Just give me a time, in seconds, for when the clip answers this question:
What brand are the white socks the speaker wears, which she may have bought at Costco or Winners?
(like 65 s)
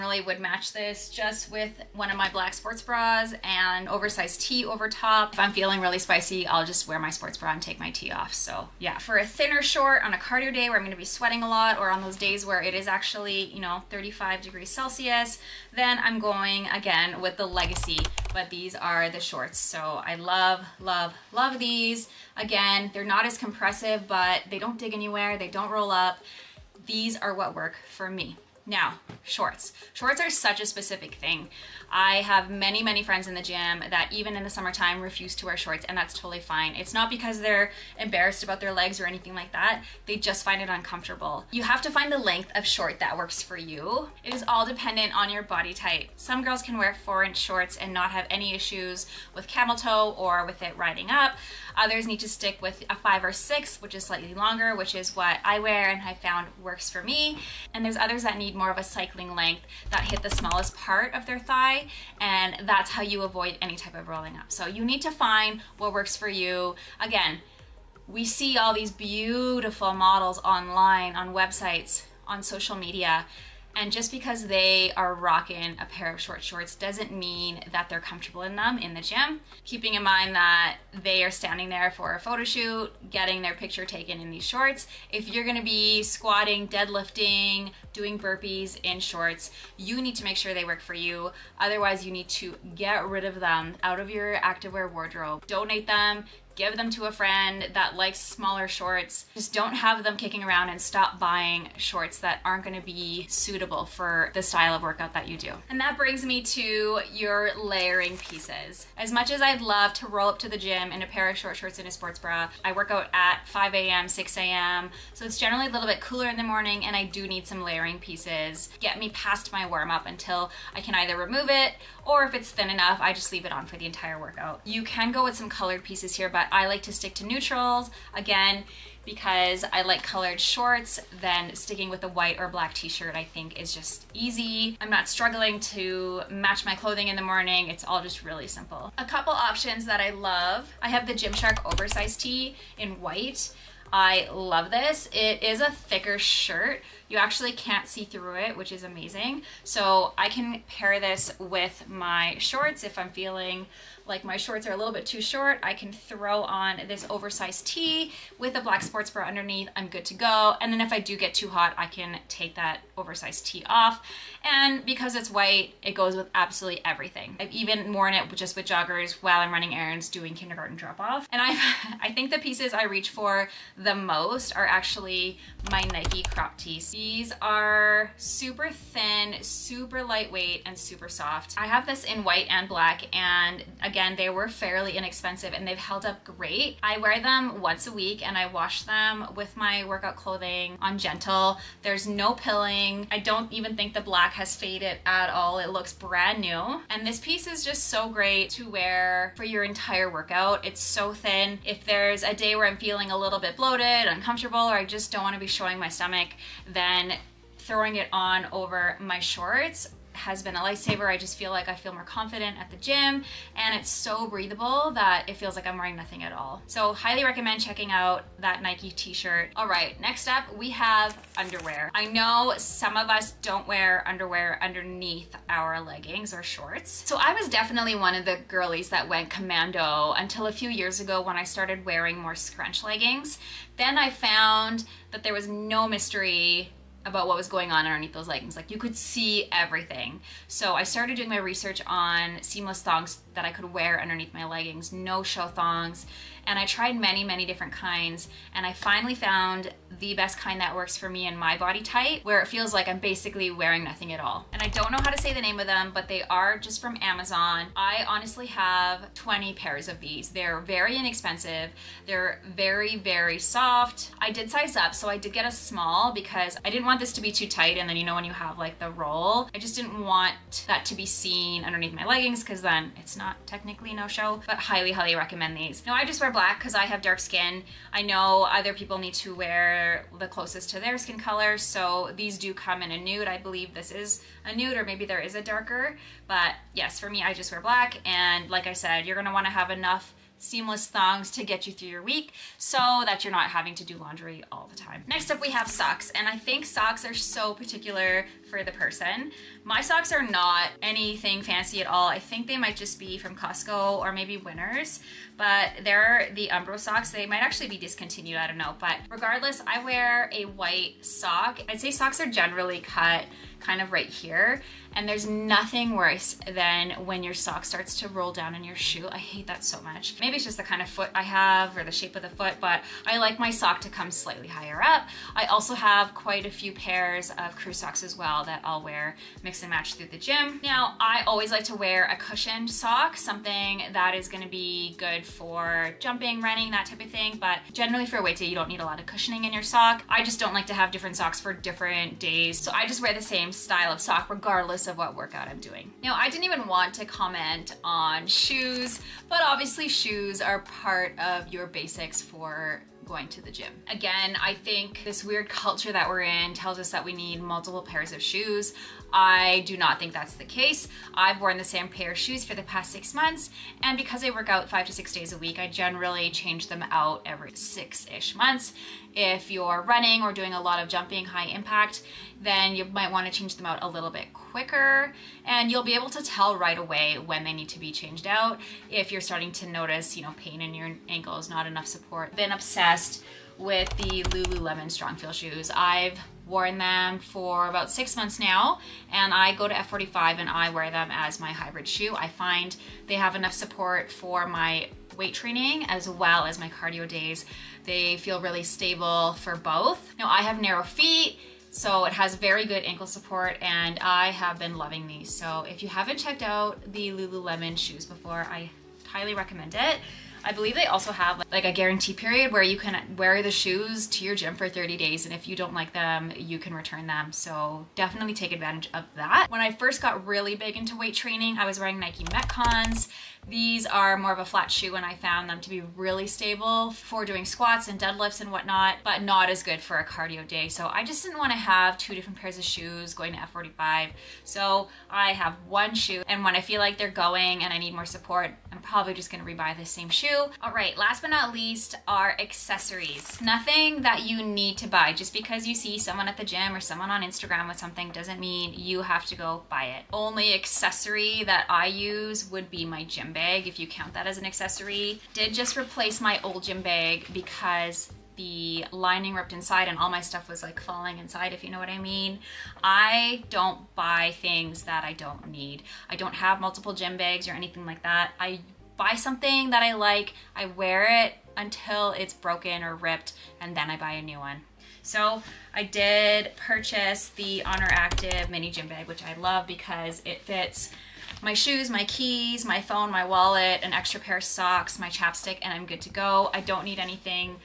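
306 s.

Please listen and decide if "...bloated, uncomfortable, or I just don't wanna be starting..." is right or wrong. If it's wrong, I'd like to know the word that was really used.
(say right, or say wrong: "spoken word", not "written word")
wrong: "showing", not "starting".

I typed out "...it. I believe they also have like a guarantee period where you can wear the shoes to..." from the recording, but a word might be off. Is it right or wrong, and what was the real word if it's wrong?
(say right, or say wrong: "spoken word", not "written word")
right.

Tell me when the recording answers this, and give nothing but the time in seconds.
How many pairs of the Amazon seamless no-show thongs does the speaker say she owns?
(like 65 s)
259 s.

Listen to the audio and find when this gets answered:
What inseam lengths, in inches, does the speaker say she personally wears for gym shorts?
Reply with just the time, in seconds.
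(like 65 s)
52 s.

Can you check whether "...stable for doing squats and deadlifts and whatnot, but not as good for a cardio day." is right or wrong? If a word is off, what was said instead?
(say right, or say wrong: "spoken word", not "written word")
right.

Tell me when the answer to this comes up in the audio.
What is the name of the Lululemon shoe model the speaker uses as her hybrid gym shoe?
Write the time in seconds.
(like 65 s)
384 s.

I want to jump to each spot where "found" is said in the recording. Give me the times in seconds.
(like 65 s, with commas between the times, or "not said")
56 s, 234 s, 249 s, 425 s.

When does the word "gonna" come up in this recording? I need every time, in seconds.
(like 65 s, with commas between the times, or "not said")
10 s, 85 s, 102 s, 289 s, 334 s, 439 s.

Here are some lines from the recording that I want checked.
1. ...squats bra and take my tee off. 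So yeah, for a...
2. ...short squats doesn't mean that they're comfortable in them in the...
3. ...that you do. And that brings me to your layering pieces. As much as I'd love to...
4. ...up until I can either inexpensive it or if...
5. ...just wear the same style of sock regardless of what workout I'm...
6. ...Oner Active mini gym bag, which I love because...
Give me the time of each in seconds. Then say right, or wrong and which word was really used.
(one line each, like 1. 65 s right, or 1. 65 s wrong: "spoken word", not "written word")
1. 7 s wrong: "sports", not "squats"
2. 76 s wrong: "shorts", not "squats"
3. 105 s right
4. 119 s wrong: "remove", not "inexpensive"
5. 342 s right
6. 477 s right.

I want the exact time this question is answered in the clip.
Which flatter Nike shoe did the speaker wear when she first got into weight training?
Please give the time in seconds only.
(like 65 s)
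422 s.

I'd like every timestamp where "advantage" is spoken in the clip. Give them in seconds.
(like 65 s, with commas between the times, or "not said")
418 s.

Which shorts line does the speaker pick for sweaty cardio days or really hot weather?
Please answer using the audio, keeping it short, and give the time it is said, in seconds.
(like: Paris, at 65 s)
Legacy, at 17 s.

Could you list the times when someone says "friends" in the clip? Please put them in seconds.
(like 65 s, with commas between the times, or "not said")
33 s, 97 s.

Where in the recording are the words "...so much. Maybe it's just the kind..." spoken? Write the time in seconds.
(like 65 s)
319 s.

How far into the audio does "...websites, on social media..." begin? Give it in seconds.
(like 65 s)
71 s.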